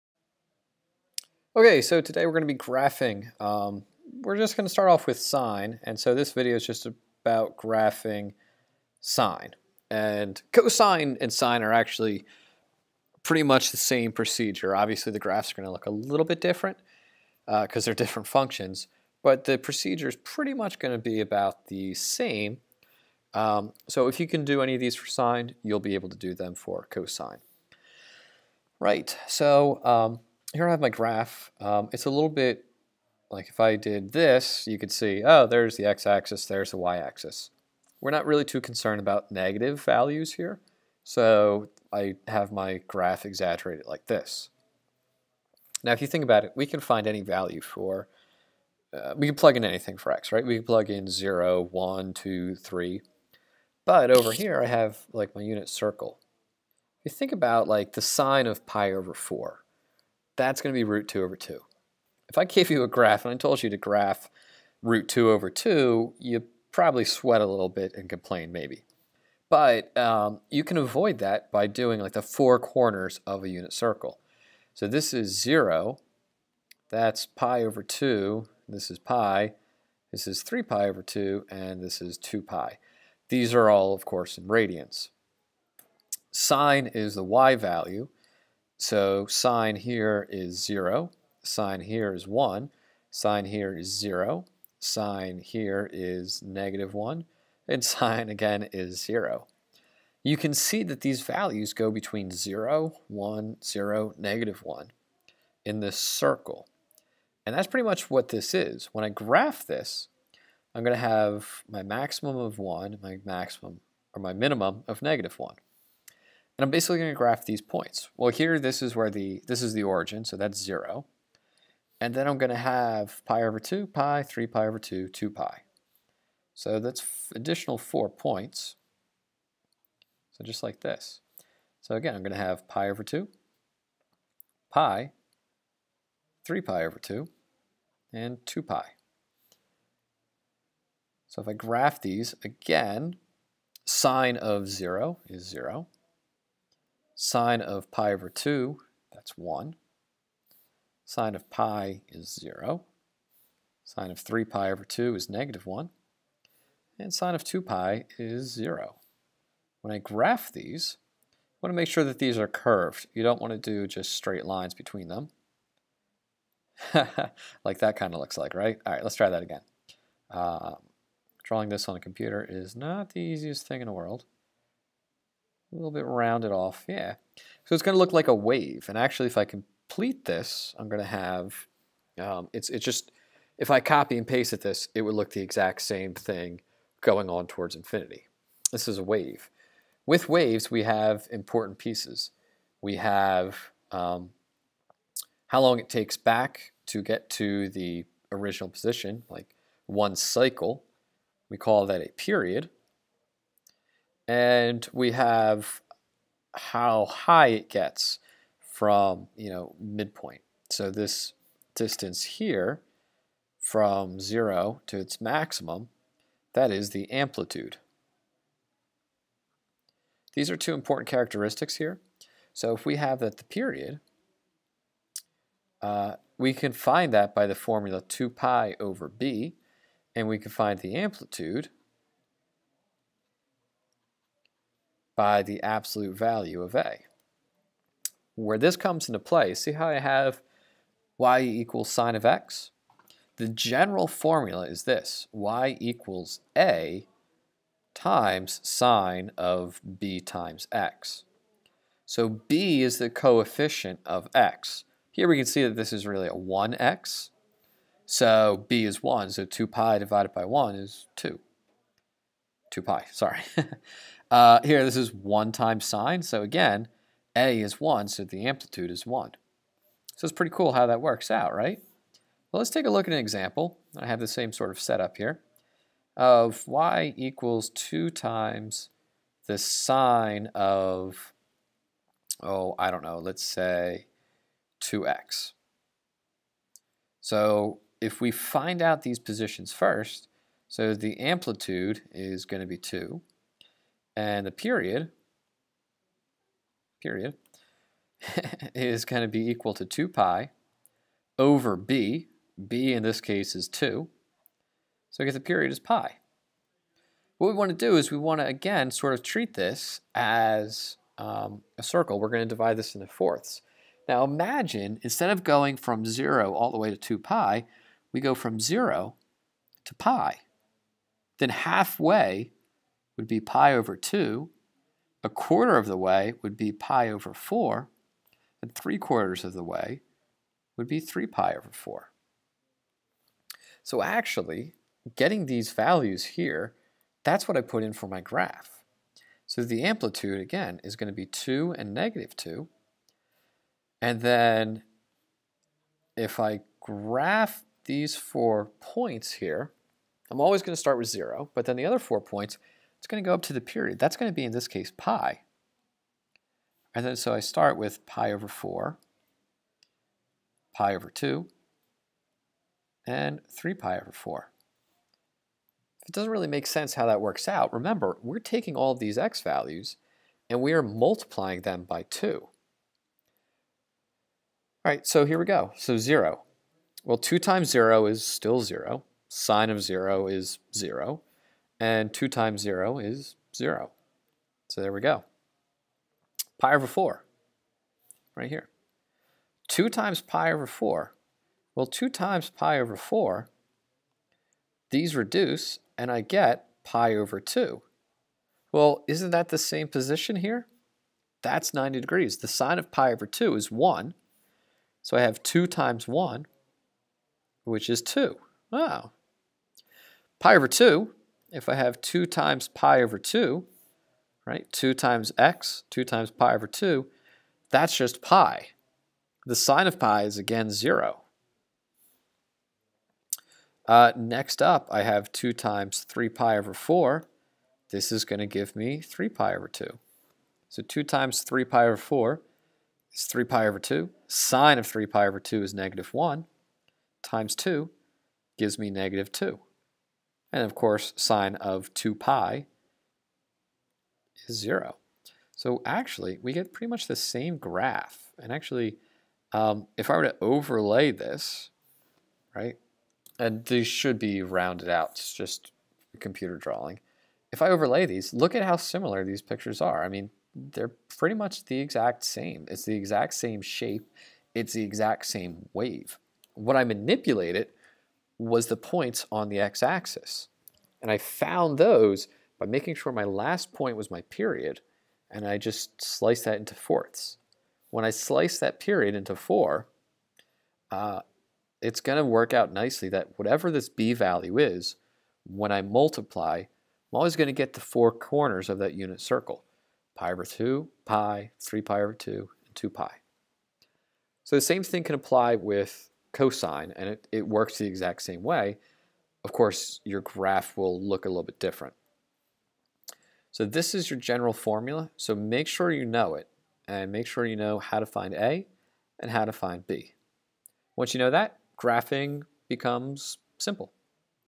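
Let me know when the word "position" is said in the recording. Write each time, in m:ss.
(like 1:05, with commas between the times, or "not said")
3:18, 4:49, 6:39.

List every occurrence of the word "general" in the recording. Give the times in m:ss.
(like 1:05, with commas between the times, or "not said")
4:03, 8:24.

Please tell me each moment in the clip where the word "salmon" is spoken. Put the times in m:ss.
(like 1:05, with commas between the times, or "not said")
not said.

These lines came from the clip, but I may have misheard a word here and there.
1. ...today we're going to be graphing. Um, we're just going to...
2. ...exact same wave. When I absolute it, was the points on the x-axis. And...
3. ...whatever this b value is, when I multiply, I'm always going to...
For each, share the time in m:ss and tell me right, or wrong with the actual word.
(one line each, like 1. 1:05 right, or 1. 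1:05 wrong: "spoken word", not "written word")
1. 0:01 right
2. 7:44 wrong: "manipulate", not "absolute"
3. 8:03 right.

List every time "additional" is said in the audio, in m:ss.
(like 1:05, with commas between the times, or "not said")
2:07.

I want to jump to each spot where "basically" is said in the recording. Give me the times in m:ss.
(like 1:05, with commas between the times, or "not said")
1:56.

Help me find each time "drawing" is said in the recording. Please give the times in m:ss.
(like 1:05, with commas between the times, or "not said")
2:51, 7:36.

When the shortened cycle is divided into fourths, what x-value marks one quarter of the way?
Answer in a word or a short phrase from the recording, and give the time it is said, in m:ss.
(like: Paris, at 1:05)
pi over 4, at 5:25.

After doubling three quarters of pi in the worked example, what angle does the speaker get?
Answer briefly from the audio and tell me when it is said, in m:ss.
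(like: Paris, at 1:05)
3 pi over 2, at 7:07.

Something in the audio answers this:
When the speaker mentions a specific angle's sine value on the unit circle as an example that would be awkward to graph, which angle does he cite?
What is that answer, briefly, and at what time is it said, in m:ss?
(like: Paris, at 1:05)
pi over 4, at 0:58.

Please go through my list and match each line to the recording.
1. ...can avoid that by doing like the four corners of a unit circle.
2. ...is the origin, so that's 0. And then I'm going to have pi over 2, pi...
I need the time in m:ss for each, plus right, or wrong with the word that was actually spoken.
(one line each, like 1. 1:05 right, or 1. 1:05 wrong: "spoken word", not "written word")
1. 1:10 right
2. 1:59 right.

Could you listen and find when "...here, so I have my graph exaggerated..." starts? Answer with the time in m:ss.
0:40.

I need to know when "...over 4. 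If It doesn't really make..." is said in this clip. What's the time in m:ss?
6:03.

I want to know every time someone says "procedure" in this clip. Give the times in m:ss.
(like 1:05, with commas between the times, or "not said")
0:14, 0:19.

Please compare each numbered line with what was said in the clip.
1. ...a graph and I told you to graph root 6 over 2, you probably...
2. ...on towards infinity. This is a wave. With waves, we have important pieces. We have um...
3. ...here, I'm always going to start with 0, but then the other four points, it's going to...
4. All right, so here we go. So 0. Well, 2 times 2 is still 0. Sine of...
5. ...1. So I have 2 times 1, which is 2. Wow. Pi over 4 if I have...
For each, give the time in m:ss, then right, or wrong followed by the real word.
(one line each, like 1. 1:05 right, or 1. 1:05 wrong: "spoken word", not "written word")
1. 1:02 wrong: "2", not "6"
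2. 3:07 right
3. 5:49 right
4. 6:12 wrong: "0", not "2"
5. 6:43 wrong: "2", not "4".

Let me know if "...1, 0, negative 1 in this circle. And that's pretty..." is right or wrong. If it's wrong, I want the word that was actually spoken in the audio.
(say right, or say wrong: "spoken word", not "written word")
right.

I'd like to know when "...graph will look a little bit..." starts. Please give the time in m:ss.
8:20.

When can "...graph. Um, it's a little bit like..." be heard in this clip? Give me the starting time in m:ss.
0:30.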